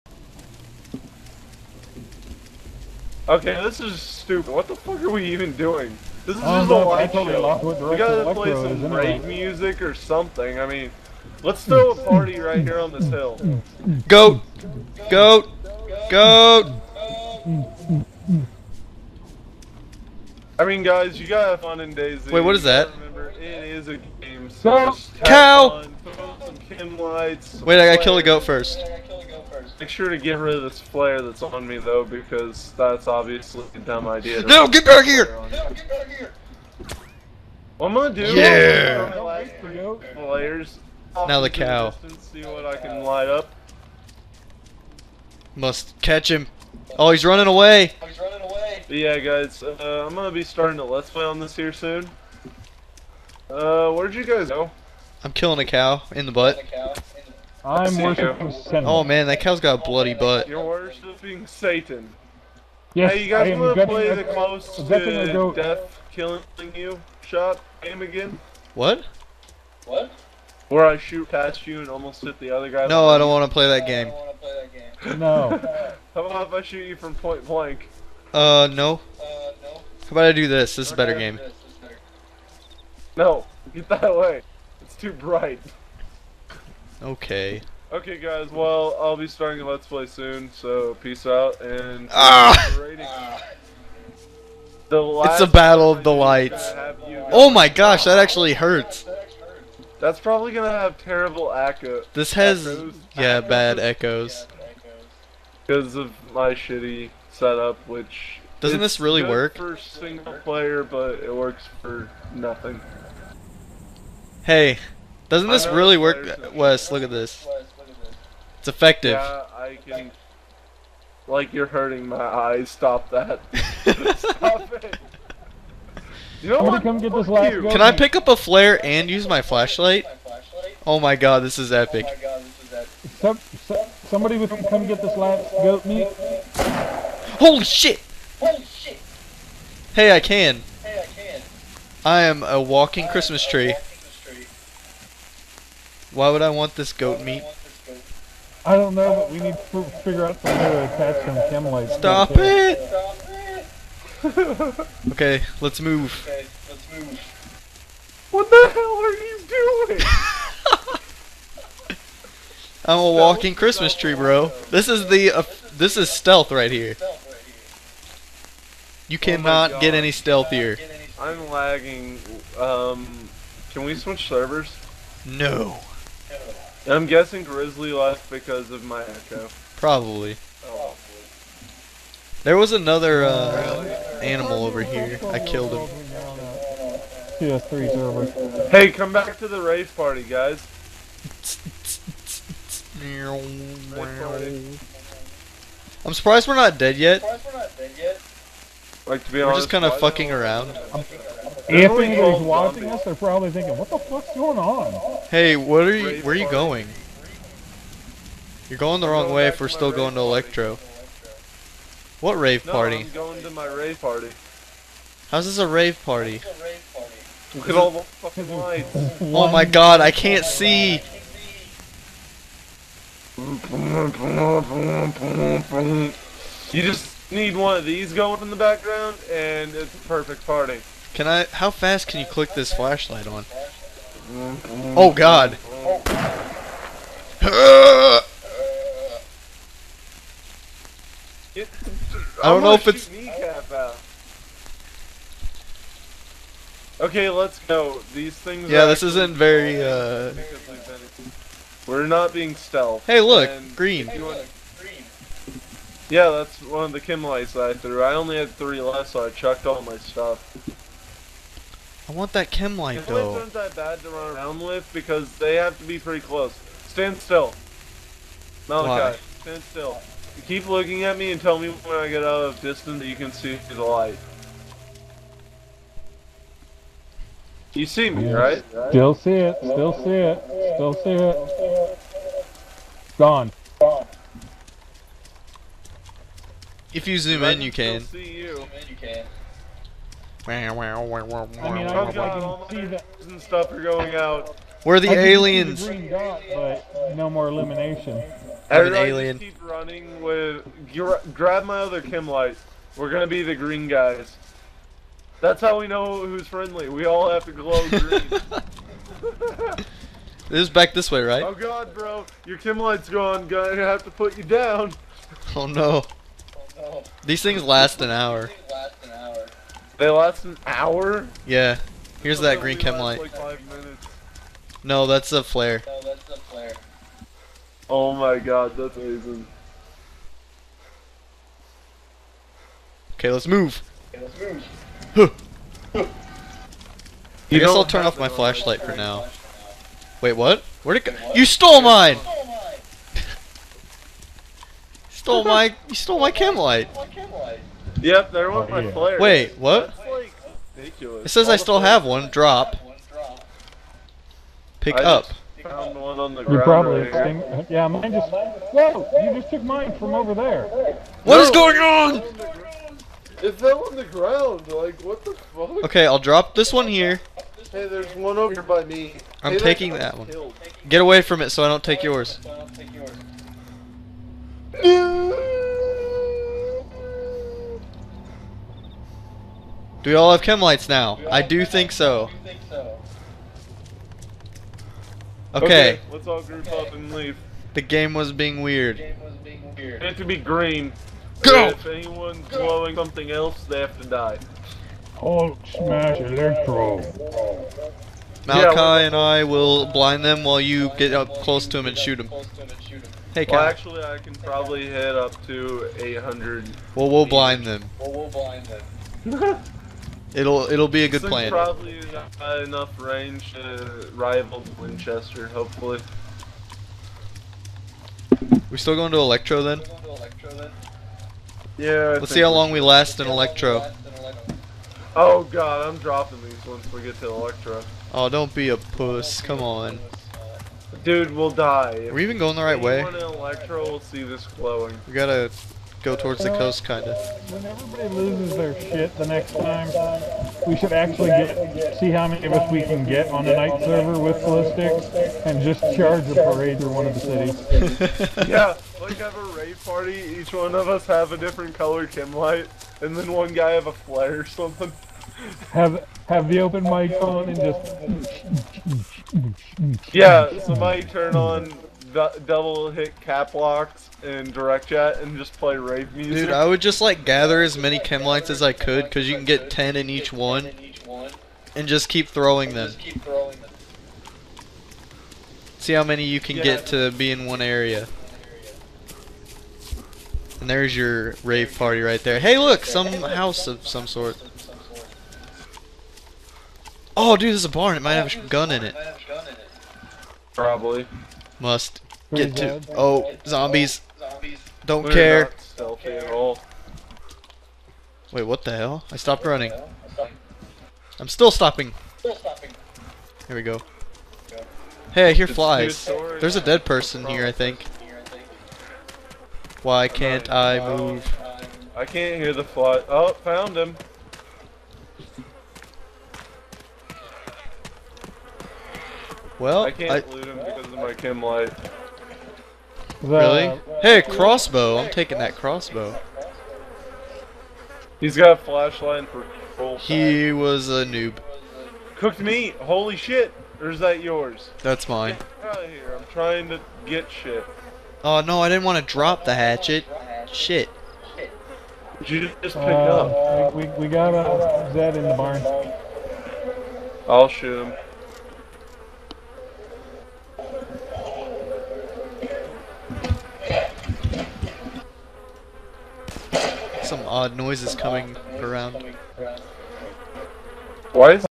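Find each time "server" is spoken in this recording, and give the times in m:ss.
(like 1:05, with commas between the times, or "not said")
2:54, 3:07, 7:23.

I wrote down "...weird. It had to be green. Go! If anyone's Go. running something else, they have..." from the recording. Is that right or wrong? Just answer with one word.
wrong.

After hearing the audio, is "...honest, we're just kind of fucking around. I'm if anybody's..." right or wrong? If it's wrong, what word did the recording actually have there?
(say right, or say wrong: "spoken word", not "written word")
right.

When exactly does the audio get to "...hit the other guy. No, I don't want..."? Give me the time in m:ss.
1:12.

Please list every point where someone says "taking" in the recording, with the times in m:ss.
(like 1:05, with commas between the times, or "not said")
6:09, 8:45.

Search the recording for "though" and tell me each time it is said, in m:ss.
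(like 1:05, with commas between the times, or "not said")
0:31, 4:23.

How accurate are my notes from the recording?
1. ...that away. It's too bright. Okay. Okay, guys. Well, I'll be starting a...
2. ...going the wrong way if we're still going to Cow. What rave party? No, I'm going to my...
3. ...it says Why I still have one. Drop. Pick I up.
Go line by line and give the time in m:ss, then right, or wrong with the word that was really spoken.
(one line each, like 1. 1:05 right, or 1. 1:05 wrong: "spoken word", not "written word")
1. 1:23 right
2. 3:28 wrong: "Electro", not "Cow"
3. 5:50 wrong: "All", not "Why".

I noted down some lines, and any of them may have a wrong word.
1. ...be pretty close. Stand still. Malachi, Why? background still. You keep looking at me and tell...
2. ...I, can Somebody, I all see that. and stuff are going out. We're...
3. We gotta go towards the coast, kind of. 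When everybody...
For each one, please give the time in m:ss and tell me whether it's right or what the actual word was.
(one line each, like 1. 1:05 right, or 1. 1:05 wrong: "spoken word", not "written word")
1. 4:25 wrong: "stand", not "background"
2. 4:50 wrong: "God", not "Somebody"
3. 7:15 right.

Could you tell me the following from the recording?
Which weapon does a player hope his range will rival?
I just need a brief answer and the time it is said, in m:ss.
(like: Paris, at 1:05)
Winchester, at 6:54.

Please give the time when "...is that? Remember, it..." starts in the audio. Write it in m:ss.
0:22.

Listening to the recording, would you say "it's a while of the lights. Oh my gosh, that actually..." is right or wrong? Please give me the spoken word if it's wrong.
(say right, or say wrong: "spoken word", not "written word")
wrong: "battle", not "while".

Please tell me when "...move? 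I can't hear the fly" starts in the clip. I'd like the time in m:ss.
8:30.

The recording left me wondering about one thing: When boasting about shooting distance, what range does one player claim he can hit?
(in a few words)
800.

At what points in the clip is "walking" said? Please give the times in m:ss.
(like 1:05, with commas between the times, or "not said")
2:22, 2:43.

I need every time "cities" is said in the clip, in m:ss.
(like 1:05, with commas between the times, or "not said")
7:27.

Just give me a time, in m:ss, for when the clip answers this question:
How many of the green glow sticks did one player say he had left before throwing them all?
4:18.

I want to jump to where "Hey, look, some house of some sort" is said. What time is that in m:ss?
8:02.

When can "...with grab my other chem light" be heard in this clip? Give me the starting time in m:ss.
5:00.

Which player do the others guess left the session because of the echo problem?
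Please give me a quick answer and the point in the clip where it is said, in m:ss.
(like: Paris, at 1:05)
Grizzly, at 2:56.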